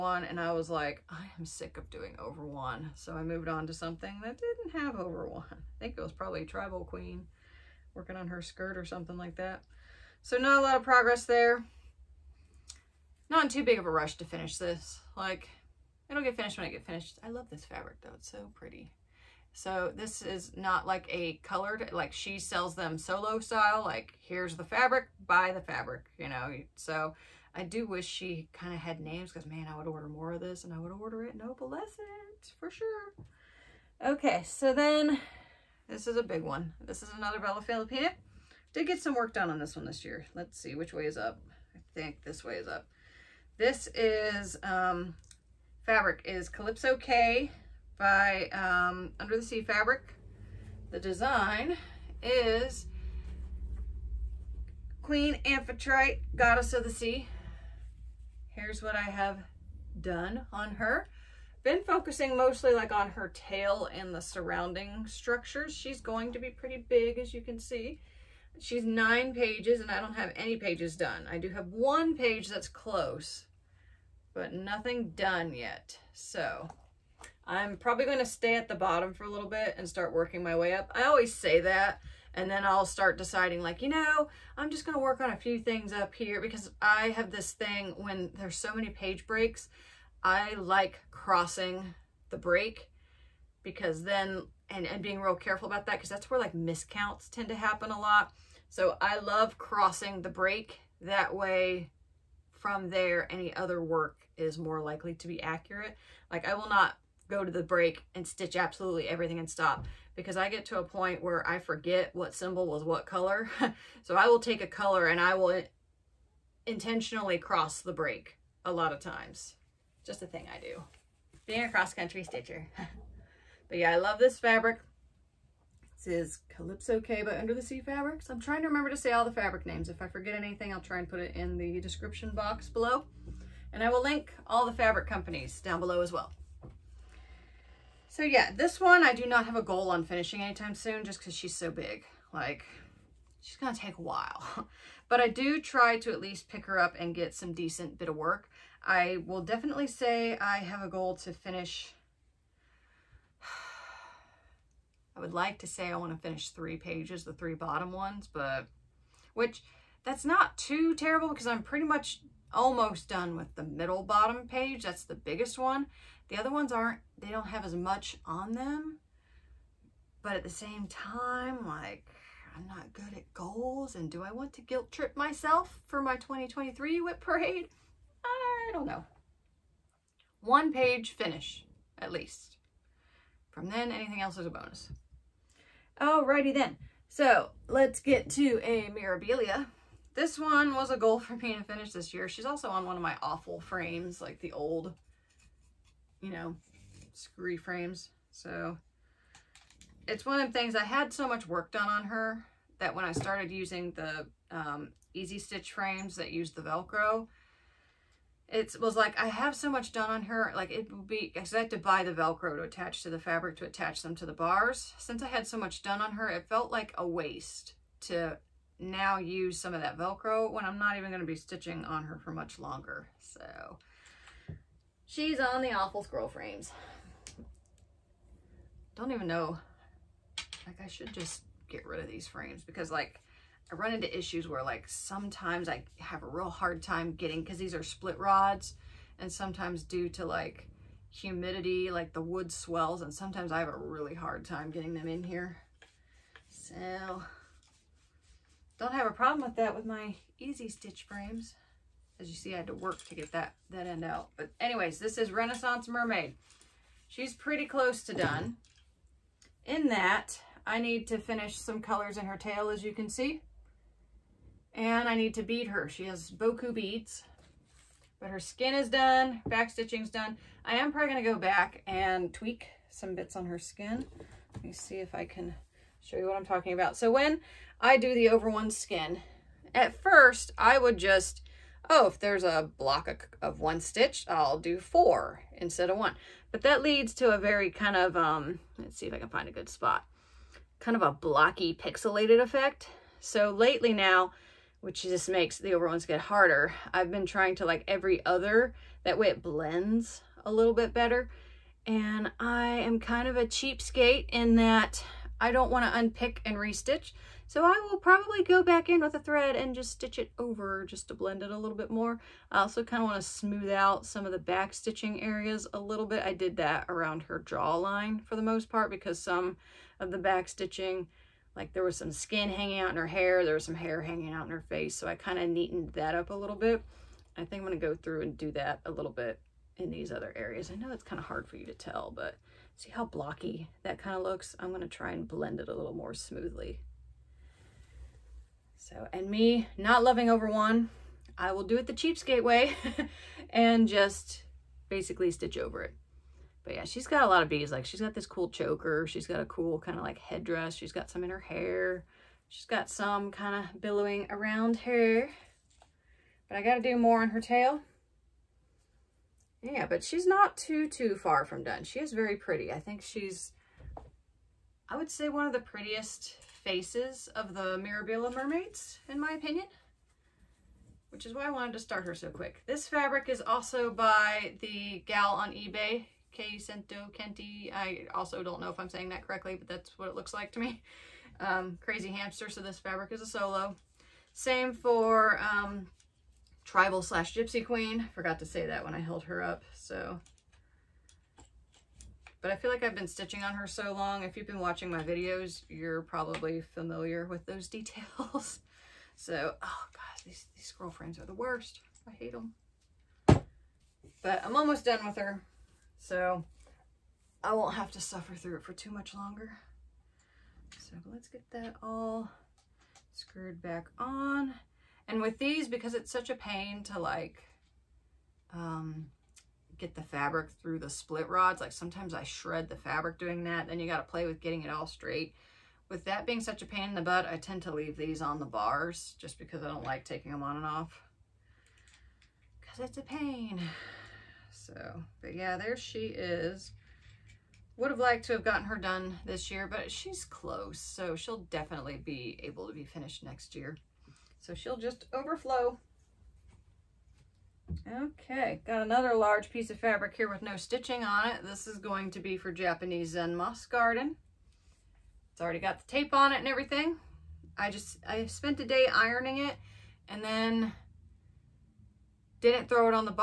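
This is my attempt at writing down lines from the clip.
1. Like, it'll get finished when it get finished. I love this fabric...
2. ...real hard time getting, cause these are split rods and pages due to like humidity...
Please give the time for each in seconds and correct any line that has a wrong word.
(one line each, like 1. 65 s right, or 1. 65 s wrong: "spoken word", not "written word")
1. 15 s right
2. 236 s wrong: "sometimes", not "pages".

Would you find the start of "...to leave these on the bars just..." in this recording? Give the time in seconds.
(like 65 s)
427 s.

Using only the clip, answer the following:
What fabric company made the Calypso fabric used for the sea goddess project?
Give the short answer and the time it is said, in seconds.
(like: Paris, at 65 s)
Under the Sea Fabrics, at 127 s.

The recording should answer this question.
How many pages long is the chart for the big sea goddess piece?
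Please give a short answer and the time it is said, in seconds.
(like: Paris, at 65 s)
9, at 68 s.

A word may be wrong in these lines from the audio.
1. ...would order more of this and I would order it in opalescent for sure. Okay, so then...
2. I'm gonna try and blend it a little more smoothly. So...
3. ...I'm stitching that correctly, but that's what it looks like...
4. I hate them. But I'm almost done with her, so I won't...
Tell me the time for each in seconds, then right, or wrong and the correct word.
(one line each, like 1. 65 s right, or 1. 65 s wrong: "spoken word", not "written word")
1. 29 s right
2. 334 s right
3. 378 s wrong: "saying", not "stitching"
4. 402 s right.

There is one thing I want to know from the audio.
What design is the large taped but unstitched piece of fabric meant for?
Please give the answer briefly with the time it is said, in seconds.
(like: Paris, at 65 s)
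Japanese Zen Moss Garden, at 452 s.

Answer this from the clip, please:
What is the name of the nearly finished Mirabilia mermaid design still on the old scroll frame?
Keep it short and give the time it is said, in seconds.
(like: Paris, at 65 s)
Renaissance Mermaid, at 255 s.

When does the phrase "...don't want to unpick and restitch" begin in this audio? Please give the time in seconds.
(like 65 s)
305 s.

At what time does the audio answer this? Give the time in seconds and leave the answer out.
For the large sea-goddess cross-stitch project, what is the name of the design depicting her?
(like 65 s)
55 s.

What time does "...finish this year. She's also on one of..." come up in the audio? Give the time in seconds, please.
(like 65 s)
191 s.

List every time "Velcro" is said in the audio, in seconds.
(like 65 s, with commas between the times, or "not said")
206 s, 212 s, 219 s.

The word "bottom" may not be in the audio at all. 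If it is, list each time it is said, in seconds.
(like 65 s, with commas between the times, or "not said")
78 s, 157 s, 164 s.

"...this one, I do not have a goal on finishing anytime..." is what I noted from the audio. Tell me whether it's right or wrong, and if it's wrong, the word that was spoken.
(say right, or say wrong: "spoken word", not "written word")
right.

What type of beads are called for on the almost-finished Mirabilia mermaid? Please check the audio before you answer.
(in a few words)
Boku beads.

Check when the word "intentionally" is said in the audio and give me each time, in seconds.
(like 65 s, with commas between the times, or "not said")
116 s.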